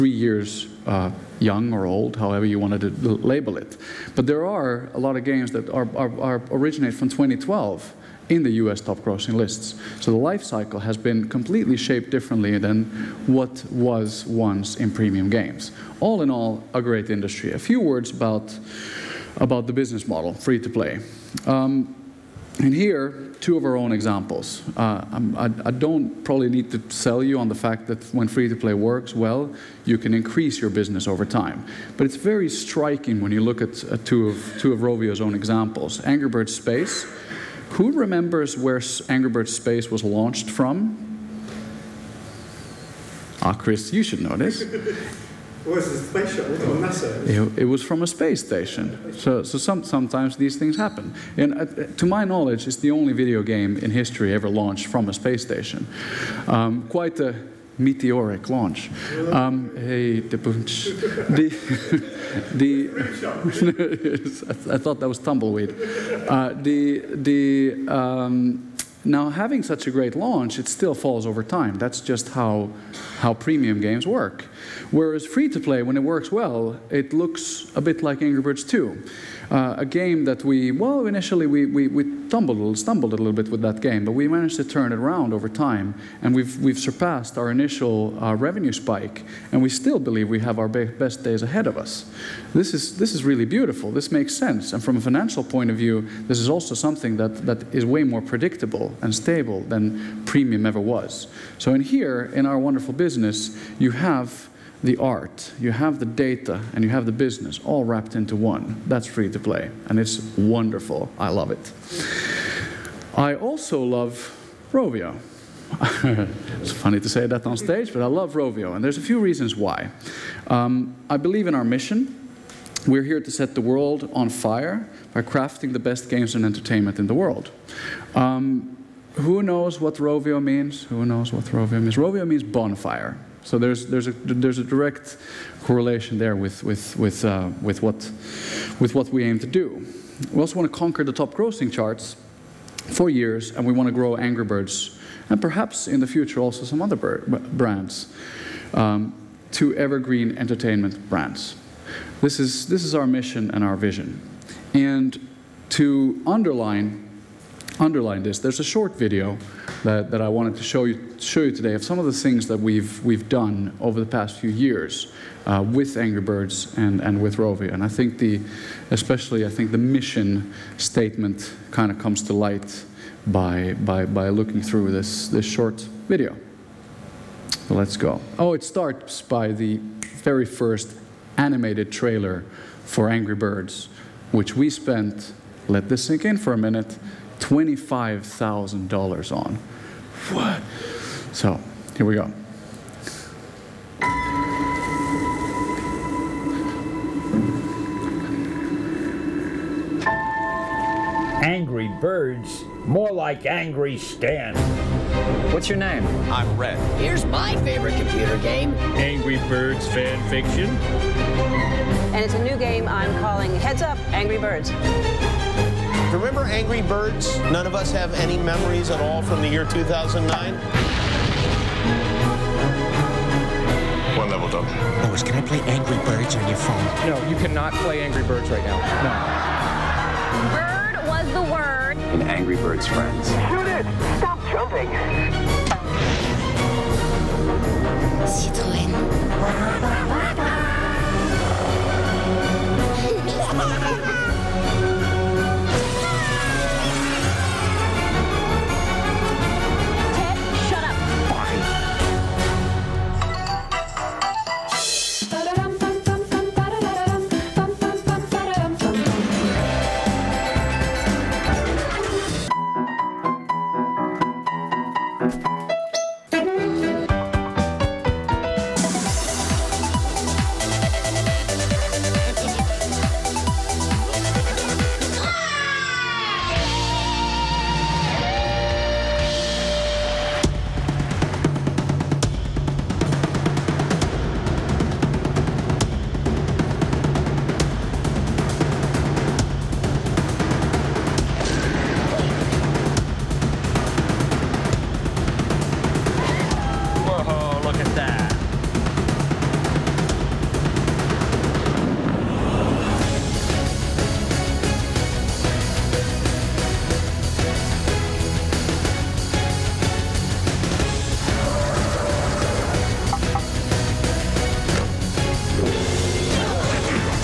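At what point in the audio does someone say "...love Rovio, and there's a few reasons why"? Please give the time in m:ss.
1:58.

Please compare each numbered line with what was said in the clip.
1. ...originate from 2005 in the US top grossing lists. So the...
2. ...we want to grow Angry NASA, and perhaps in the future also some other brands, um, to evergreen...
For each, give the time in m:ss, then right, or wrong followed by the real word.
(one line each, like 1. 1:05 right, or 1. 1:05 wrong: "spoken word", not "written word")
1. 0:06 wrong: "2012", not "2005"
2. 2:23 wrong: "Birds", not "NASA".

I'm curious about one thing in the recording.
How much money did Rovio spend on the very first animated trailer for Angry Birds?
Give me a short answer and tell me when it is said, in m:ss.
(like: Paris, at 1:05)
$25,000, at 3:07.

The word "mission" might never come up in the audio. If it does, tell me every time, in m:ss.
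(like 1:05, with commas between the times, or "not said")
2:01, 2:33, 2:49.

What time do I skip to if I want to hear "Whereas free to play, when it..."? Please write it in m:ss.
1:14.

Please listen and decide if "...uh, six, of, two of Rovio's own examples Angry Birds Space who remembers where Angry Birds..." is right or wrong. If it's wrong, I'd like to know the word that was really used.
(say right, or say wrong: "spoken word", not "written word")
wrong: "two", not "six".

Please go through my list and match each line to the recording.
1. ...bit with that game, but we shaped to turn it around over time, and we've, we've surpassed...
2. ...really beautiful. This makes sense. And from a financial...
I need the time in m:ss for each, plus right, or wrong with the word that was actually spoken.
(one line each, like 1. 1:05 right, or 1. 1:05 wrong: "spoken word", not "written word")
1. 1:23 wrong: "managed", not "shaped"
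2. 1:33 right.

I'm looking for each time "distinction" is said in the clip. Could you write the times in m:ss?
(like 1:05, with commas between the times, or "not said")
not said.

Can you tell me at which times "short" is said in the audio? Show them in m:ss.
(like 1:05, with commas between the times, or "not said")
2:38, 2:55.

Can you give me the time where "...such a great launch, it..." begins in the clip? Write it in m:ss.
1:09.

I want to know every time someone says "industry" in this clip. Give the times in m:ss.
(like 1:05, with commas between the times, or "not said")
0:17.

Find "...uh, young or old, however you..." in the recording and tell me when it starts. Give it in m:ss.
0:00.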